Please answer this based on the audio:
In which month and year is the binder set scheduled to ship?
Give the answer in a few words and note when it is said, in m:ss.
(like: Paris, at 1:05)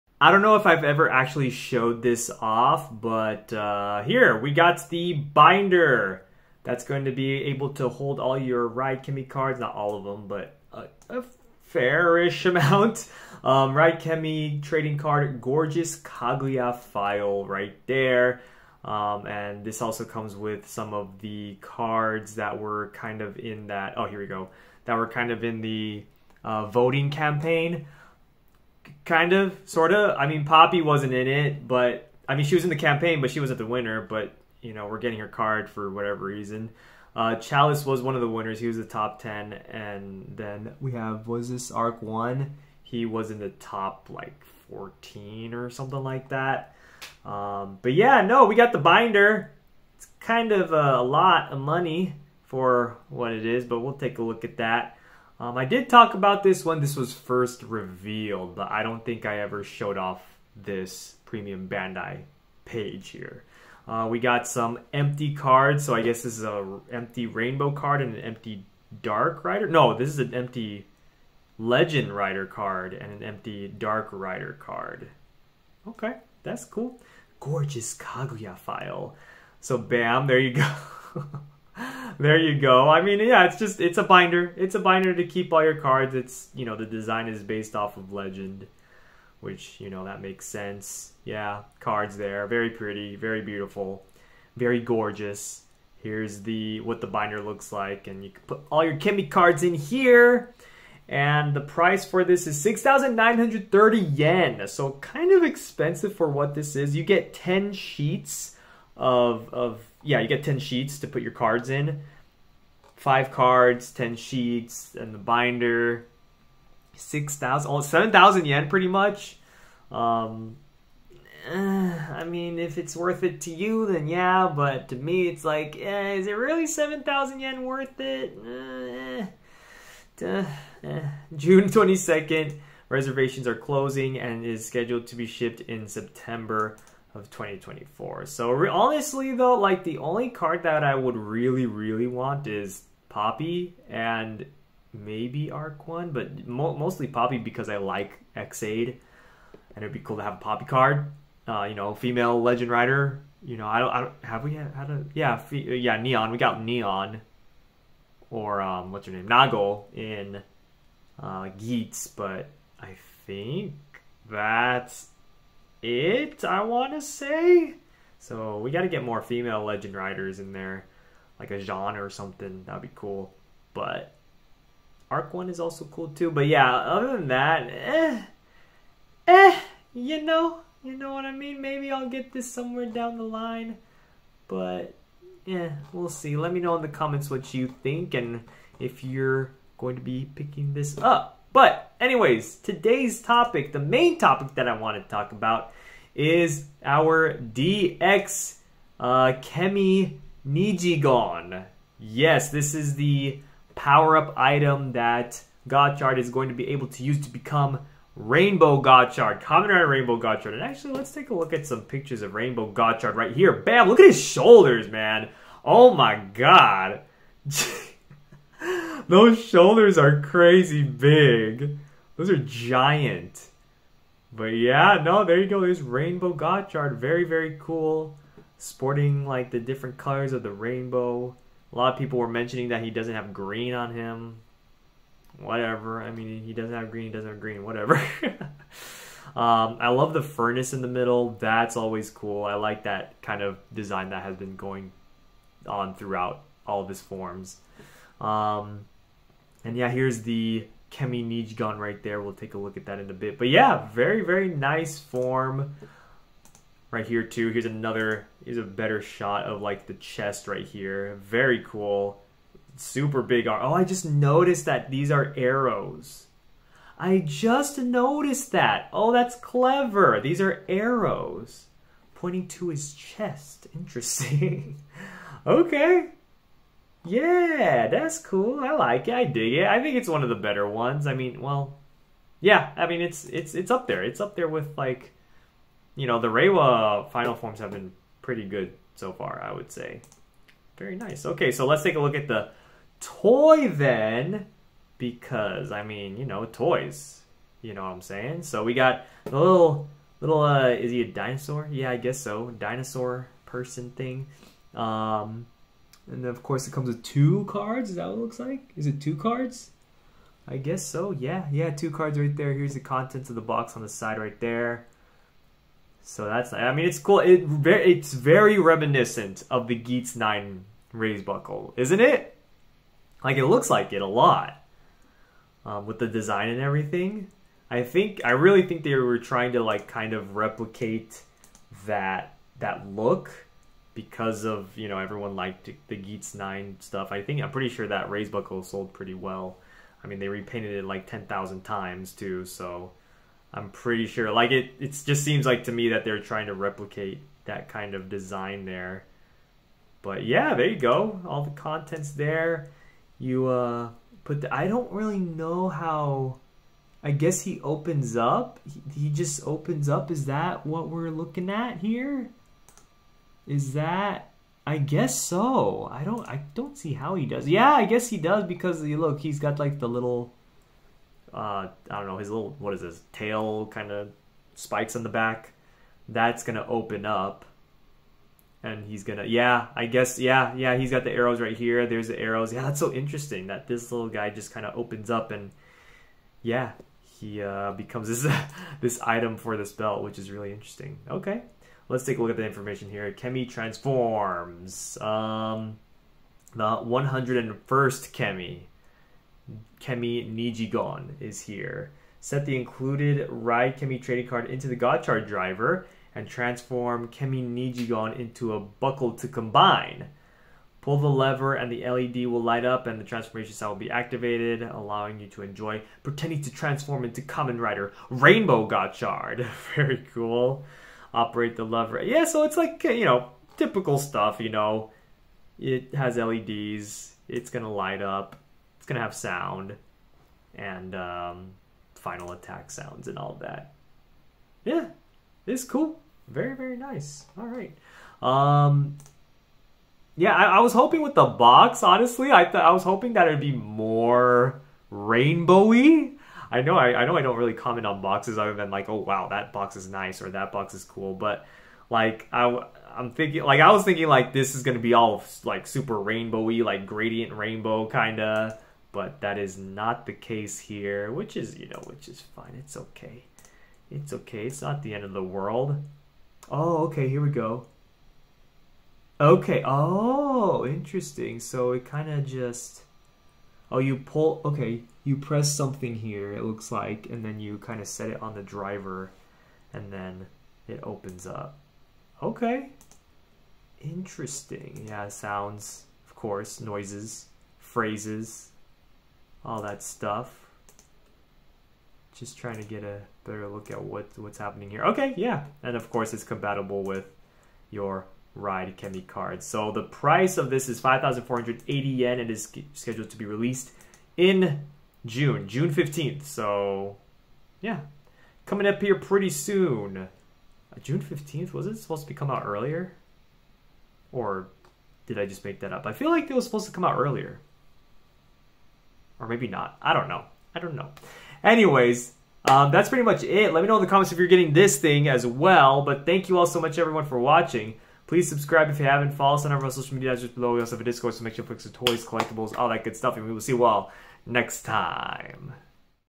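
September 2024, at 2:15.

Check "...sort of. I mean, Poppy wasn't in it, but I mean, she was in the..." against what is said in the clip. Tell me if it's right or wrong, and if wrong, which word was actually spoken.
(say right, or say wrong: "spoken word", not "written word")
right.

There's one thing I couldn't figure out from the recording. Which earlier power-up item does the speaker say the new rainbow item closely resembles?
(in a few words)
Geats 9 raise buckle.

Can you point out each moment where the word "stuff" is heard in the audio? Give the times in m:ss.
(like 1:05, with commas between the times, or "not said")
5:36, 7:03, 8:09, 8:52.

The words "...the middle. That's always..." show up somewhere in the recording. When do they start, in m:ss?
4:00.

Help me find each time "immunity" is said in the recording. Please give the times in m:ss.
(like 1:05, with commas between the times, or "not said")
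not said.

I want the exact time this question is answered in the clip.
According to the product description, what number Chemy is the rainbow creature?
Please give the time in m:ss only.
6:36.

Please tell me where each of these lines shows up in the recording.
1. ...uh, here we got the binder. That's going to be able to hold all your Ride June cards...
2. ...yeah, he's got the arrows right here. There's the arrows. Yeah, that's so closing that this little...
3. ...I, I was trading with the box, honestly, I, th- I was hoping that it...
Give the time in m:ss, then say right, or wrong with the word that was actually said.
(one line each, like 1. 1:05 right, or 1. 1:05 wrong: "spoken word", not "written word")
1. 0:03 wrong: "Chemy", not "June"
2. 6:20 wrong: "interesting", not "closing"
3. 7:20 wrong: "hoping", not "trading".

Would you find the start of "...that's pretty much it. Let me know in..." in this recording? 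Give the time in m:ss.
8:42.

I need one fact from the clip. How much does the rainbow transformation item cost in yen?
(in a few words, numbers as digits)
5,480 yen.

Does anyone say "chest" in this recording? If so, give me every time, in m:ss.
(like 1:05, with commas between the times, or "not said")
4:19, 4:32.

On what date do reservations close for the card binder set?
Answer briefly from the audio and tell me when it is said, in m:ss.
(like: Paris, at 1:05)
June 22nd, at 2:11.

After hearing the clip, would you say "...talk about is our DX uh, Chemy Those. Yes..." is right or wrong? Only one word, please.
wrong.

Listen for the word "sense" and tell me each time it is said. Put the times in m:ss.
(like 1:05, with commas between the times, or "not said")
1:30.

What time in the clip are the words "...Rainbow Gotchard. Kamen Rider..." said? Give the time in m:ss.
3:28.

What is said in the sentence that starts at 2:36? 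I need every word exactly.
We got Neon, or um, what's her name Nagle in uh, but I think that's it, I want to say.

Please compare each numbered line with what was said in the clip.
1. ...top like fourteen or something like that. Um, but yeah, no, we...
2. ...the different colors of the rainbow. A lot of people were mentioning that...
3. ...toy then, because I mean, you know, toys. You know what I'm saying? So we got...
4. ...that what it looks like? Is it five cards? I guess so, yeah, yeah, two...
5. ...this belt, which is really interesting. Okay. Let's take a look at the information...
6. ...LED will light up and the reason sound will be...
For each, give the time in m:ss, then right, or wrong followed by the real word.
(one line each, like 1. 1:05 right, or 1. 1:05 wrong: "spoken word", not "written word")
1. 0:43 right
2. 3:49 right
3. 4:52 right
4. 5:07 wrong: "two", not "five"
5. 6:29 right
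6. 6:51 wrong: "transformation", not "reason".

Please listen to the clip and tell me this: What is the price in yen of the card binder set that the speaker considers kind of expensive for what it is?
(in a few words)
6,930 yen.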